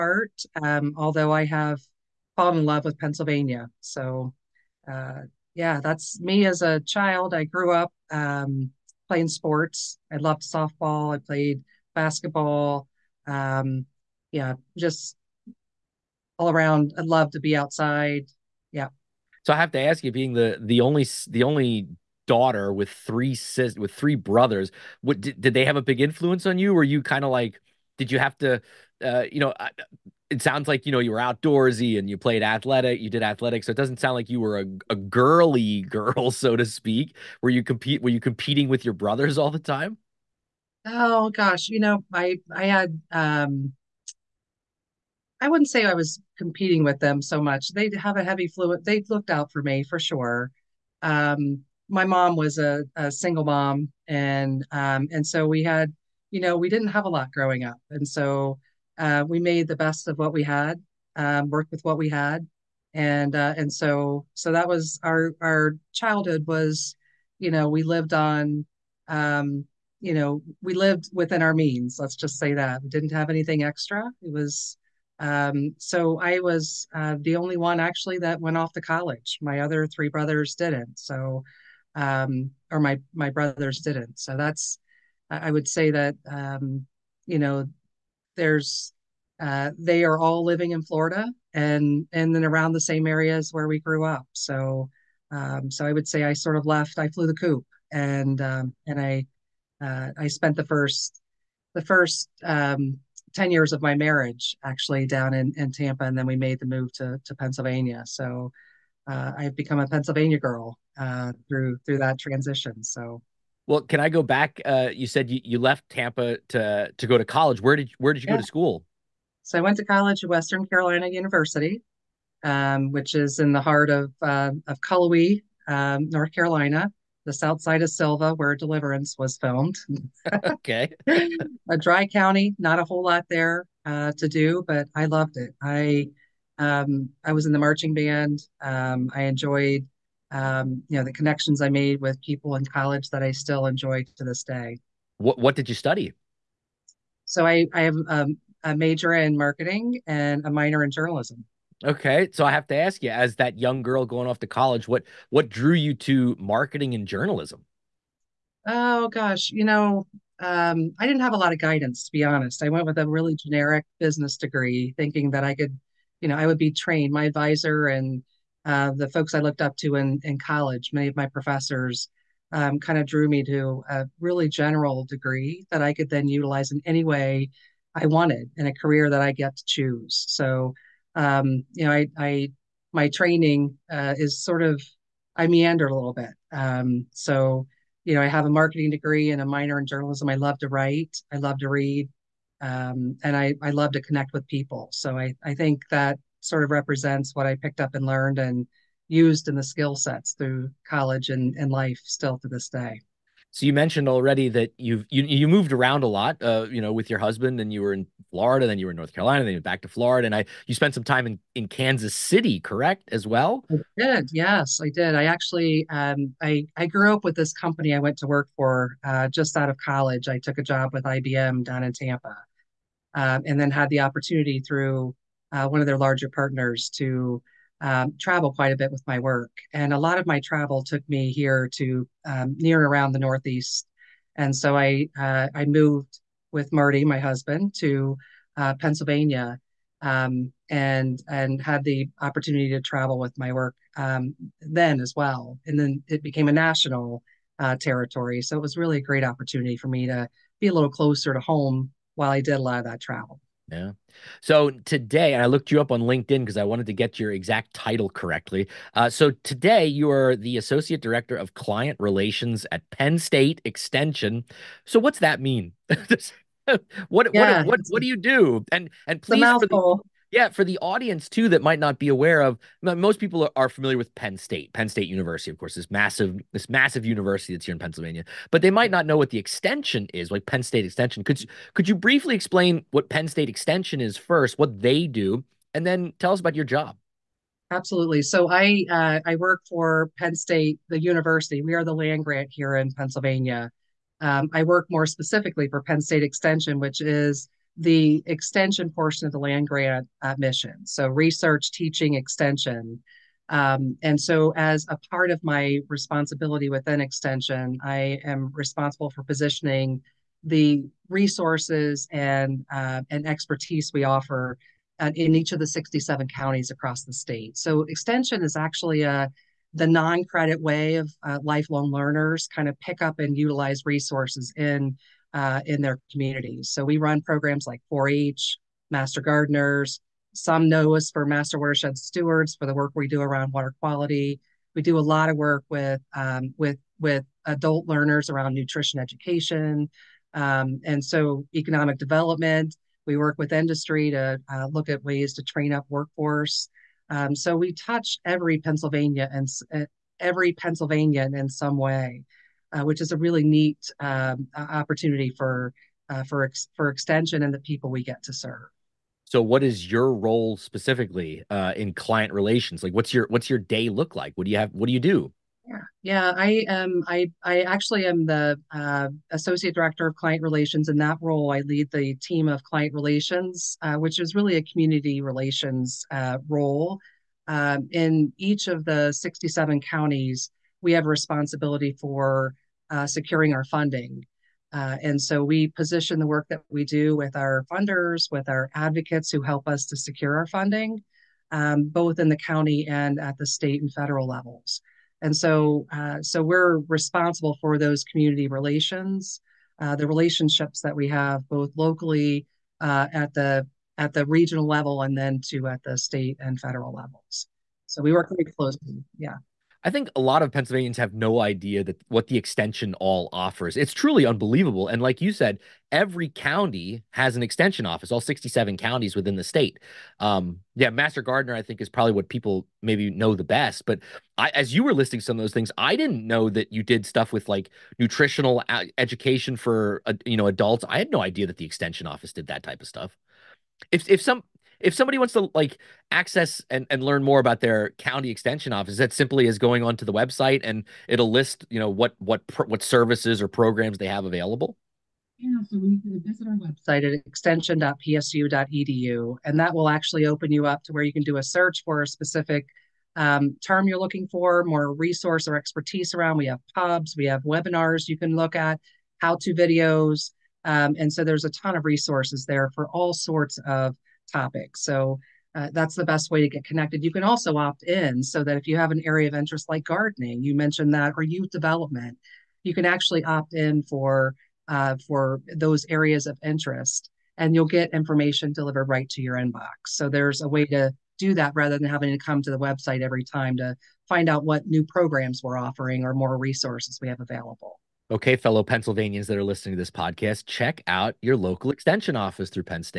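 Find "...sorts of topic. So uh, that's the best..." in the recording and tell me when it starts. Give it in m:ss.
7:43.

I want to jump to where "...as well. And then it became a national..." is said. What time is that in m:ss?
4:04.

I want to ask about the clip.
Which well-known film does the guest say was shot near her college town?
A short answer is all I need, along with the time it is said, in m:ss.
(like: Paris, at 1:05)
Deliverance, at 2:08.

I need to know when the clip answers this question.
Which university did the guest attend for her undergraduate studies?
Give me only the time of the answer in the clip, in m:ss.
2:00.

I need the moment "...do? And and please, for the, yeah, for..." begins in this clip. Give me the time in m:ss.
4:28.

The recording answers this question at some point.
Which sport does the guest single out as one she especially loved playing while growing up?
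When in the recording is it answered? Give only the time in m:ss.
0:10.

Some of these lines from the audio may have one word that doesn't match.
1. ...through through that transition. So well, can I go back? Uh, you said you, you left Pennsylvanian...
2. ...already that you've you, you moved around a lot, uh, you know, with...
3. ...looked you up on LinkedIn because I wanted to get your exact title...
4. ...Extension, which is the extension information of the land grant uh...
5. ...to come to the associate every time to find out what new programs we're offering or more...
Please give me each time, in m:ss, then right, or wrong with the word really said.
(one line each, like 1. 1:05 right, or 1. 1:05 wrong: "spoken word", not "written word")
1. 1:51 wrong: "Tampa", not "Pennsylvanian"
2. 3:24 right
3. 4:15 right
4. 4:56 wrong: "portion", not "information"
5. 8:02 wrong: "website", not "associate".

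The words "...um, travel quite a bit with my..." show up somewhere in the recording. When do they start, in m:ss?
3:47.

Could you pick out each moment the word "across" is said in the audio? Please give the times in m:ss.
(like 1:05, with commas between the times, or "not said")
5:16.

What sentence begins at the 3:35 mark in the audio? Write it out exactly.
I actually, um, I I grew up with this company I went to work for uh, just out of college.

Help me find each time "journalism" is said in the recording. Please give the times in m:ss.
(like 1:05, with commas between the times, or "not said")
2:30, 2:37, 3:09.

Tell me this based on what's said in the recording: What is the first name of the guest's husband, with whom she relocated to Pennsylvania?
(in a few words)
Marty.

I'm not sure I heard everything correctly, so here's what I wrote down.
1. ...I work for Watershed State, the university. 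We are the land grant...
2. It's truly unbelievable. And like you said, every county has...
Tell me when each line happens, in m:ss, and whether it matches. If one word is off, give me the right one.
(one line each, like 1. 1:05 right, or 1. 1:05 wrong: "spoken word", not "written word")
1. 4:49 wrong: "Penn", not "Watershed"
2. 6:53 right.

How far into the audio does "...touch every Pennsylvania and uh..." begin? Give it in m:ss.
5:47.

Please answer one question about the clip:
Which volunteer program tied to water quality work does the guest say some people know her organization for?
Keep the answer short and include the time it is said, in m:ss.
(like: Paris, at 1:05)
Master Watershed Stewards, at 5:31.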